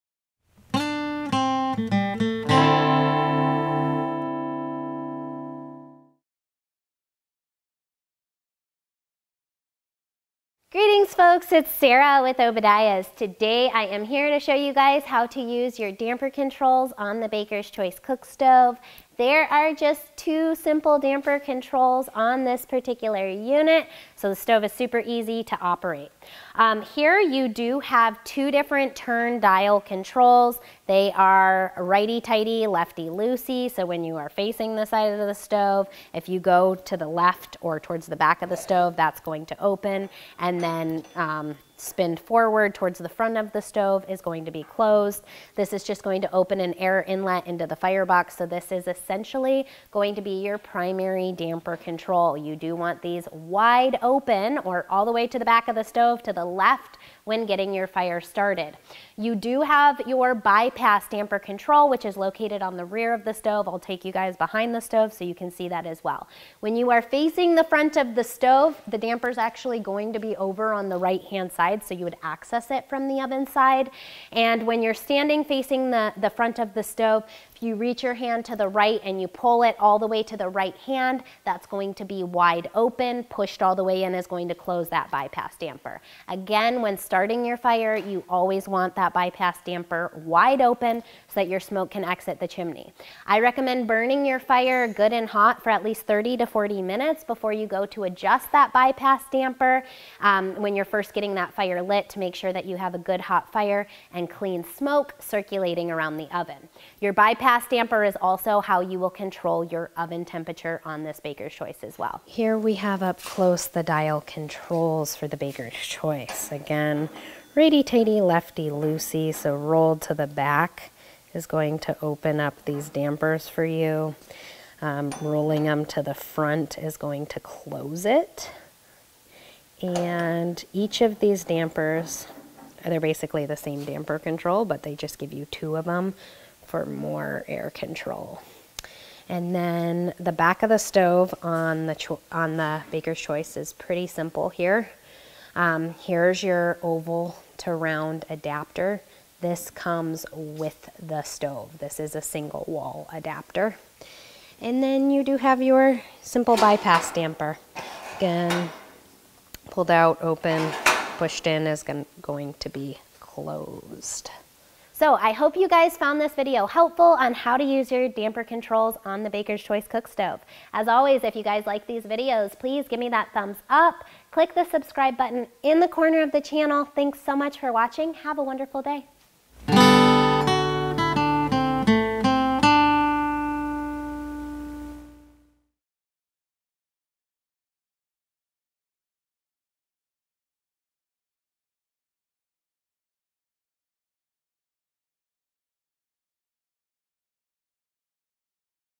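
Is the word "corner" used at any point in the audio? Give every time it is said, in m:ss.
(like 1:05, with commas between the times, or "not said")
2:55.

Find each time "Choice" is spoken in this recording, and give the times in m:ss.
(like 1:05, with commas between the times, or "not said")
0:17, 1:51, 1:55, 2:23, 2:49.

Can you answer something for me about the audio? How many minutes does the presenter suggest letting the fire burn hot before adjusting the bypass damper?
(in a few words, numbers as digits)
30 to 40 minutes.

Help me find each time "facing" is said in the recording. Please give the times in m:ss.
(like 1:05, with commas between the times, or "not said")
0:34, 1:07, 1:15.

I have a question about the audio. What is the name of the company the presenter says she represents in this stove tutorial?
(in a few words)
Obadiah's.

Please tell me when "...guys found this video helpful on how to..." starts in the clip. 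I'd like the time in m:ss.
2:45.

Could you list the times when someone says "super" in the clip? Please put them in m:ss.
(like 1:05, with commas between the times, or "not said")
0:24.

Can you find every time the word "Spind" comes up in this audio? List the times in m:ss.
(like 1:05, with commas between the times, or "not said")
0:41.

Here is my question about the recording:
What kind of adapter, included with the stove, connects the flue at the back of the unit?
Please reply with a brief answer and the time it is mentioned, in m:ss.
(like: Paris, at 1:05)
oval to round adapter, at 2:26.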